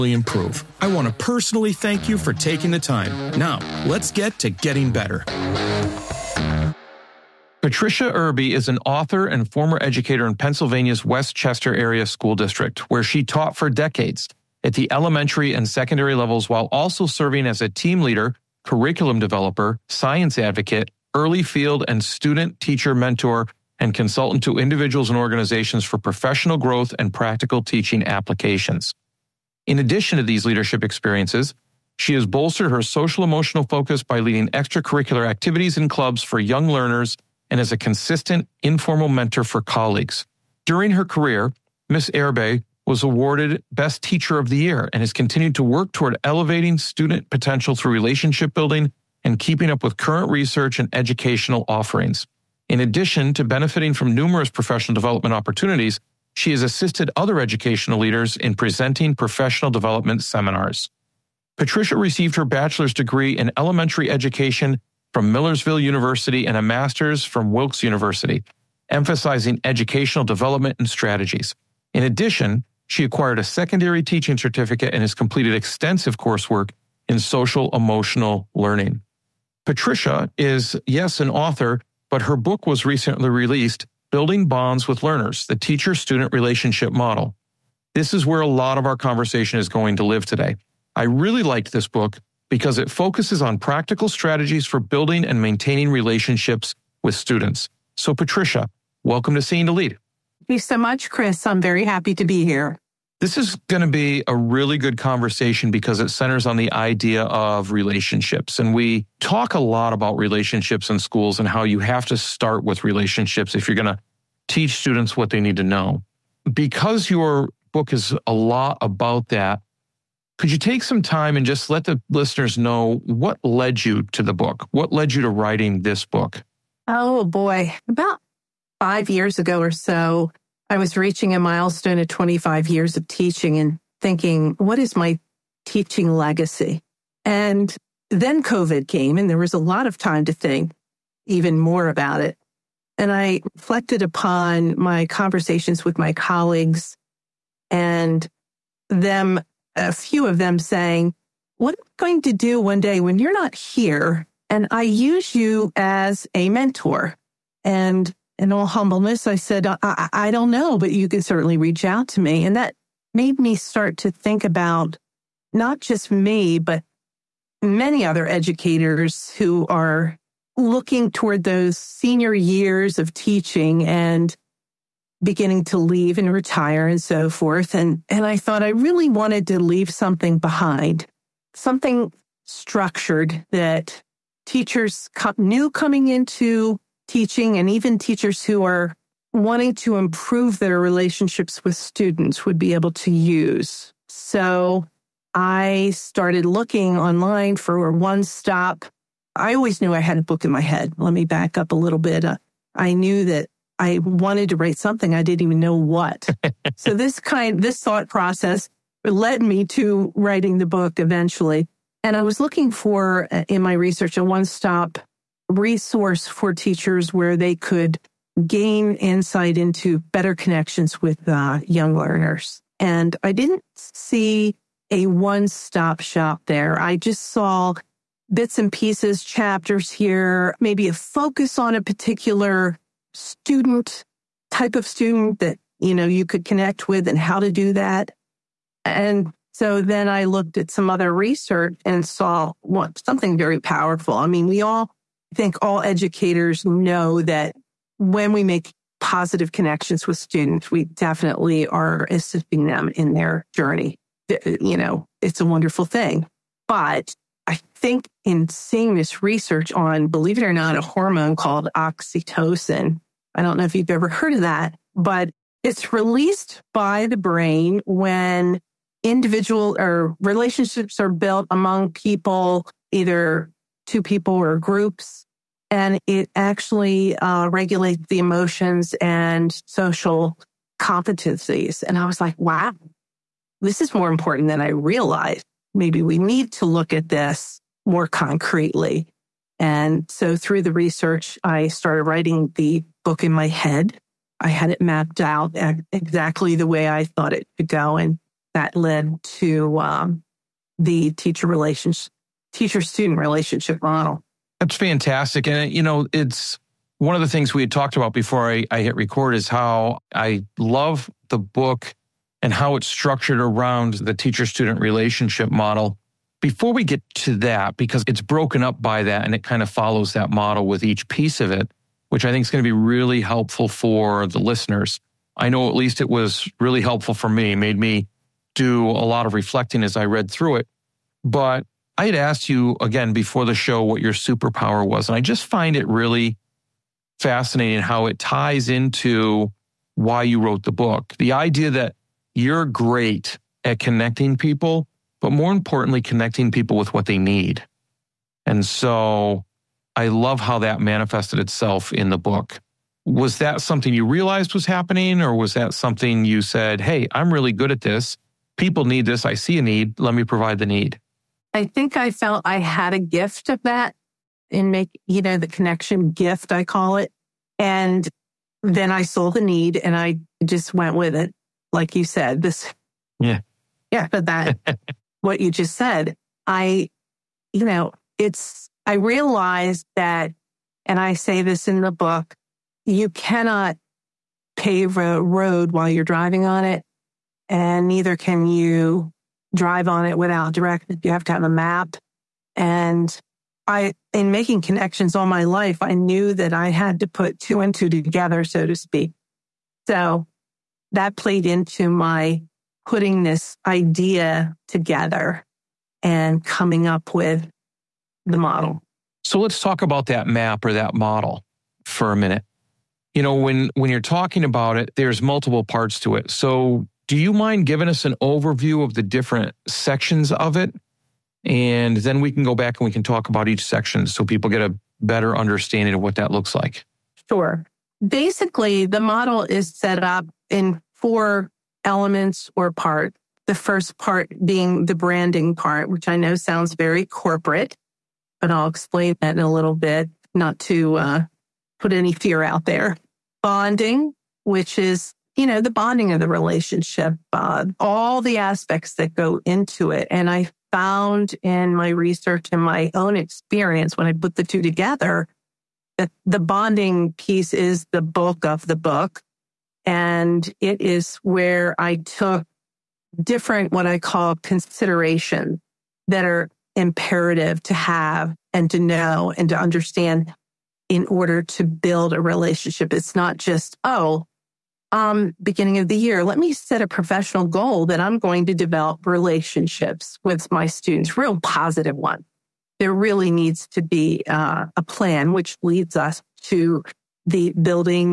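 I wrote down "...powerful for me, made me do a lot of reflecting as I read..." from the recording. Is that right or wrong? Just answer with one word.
wrong.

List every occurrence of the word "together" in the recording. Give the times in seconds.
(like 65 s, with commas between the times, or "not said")
397 s, 404 s, 454 s.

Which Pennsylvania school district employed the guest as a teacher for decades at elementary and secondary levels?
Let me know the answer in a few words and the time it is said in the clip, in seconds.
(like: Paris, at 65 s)
West Chester Area School District, at 11 s.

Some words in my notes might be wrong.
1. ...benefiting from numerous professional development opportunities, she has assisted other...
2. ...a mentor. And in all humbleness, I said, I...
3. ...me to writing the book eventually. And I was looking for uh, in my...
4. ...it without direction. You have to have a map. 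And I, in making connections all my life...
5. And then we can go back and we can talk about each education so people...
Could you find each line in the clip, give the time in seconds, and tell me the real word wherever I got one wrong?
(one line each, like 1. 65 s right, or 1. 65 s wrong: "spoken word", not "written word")
1. 53 s right
2. 156 s right
3. 209 s right
4. 390 s right
5. 421 s wrong: "section", not "education".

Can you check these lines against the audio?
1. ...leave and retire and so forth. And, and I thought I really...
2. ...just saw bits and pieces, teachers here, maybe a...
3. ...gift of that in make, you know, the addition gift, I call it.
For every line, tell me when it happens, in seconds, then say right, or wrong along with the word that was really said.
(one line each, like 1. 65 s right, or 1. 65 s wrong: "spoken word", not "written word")
1. 175 s right
2. 226 s wrong: "chapters", not "teachers"
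3. 362 s wrong: "connection", not "addition".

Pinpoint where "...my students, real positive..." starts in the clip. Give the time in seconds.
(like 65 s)
480 s.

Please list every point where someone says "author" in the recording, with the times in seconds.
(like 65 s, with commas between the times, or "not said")
8 s, 81 s.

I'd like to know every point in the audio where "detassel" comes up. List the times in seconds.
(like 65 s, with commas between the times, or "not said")
not said.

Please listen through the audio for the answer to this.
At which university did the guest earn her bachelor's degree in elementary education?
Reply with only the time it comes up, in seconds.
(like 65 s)
65 s.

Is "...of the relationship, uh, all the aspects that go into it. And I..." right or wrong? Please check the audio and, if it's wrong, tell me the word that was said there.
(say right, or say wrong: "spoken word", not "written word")
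right.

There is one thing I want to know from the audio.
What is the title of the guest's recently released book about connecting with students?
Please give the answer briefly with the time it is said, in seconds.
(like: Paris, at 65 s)
Building Bonds with Learners, at 84 s.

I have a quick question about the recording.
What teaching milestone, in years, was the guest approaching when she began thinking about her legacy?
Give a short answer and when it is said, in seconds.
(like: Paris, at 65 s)
25 years, at 132 s.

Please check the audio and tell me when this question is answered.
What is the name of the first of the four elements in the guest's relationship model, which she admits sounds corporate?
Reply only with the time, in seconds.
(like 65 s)
434 s.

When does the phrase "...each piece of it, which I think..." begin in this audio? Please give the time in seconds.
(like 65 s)
320 s.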